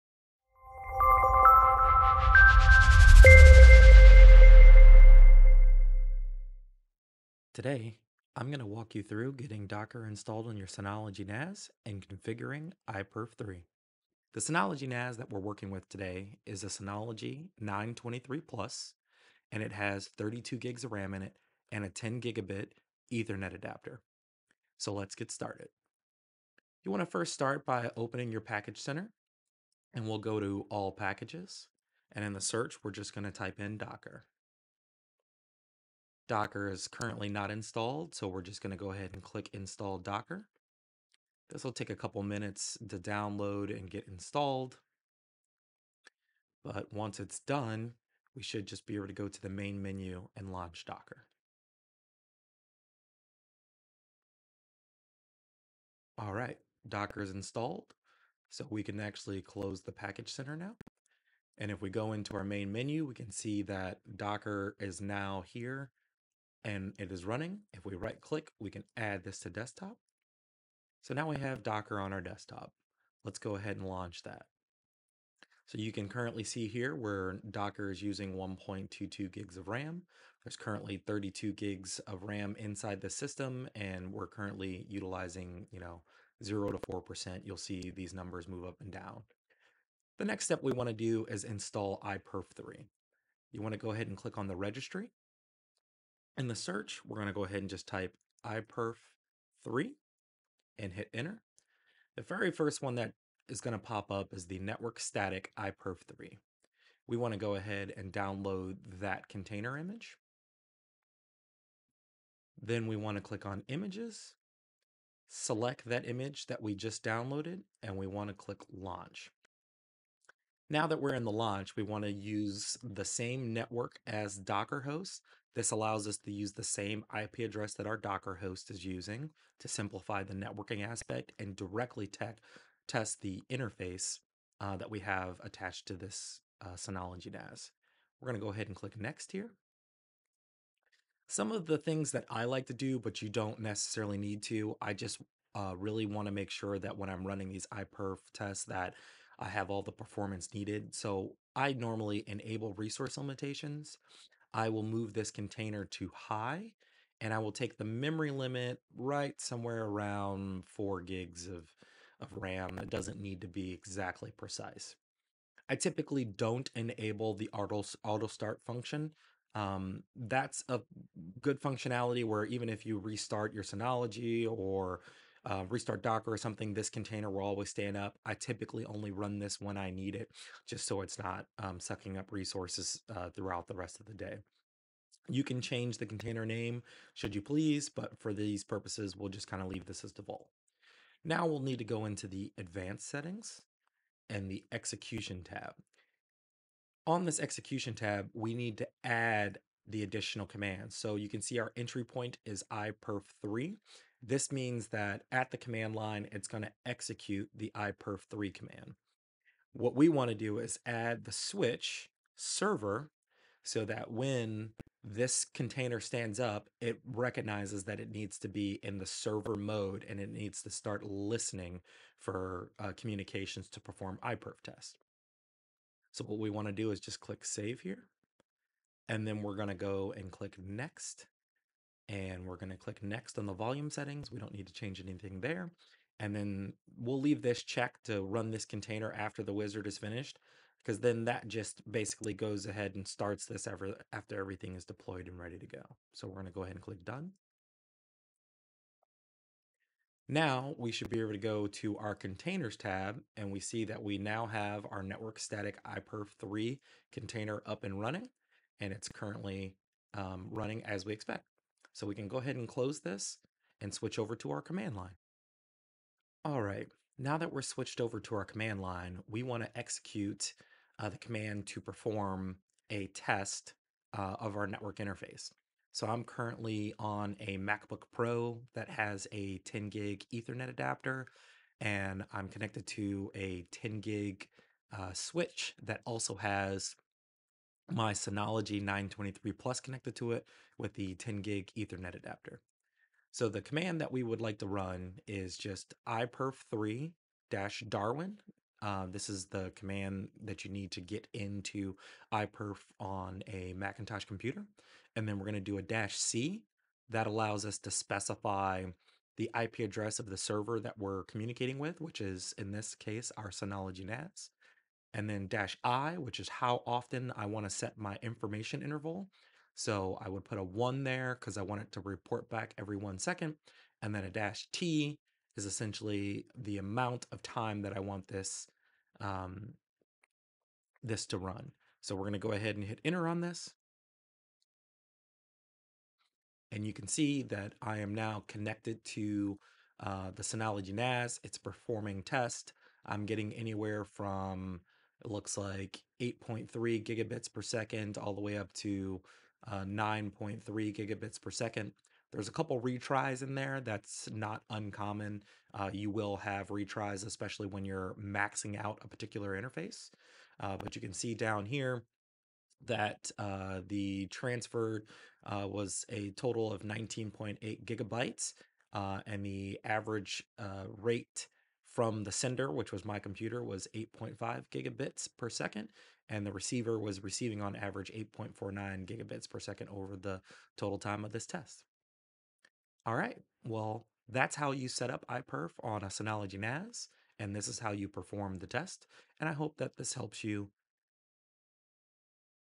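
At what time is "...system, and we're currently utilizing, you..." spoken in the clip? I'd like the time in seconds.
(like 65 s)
83 s.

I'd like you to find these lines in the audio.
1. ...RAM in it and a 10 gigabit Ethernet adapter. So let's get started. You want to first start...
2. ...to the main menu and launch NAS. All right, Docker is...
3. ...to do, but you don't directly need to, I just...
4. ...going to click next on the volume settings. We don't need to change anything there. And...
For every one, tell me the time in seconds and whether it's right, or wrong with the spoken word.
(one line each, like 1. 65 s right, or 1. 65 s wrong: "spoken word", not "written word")
1. 20 s right
2. 49 s wrong: "Docker", not "NAS"
3. 142 s wrong: "necessarily", not "directly"
4. 232 s right.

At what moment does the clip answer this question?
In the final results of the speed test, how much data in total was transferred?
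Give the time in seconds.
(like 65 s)
366 s.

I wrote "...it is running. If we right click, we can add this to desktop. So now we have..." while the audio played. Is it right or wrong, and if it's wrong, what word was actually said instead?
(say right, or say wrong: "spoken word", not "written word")
right.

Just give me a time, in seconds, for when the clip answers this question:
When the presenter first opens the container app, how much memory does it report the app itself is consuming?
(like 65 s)
78 s.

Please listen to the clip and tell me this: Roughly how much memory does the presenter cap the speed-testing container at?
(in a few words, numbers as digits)
4 GB.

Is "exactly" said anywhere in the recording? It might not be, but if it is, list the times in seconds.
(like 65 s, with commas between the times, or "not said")
163 s.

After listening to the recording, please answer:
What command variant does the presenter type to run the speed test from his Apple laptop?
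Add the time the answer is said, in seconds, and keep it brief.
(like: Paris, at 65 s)
iperf3 darwin, at 296 s.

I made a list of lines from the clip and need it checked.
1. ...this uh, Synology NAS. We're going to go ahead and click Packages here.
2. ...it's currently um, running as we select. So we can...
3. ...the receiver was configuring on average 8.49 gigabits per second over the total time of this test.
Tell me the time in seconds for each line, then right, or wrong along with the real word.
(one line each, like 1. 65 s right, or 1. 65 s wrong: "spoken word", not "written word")
1. 135 s wrong: "Next", not "Packages"
2. 258 s wrong: "expect", not "select"
3. 376 s wrong: "receiving", not "configuring".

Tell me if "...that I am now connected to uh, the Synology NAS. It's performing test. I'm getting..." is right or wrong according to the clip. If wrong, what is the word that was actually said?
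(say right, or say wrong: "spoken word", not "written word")
right.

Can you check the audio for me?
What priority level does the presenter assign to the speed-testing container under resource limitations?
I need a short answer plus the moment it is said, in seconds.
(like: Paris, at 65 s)
high, at 156 s.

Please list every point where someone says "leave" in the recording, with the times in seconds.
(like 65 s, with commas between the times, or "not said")
189 s, 237 s.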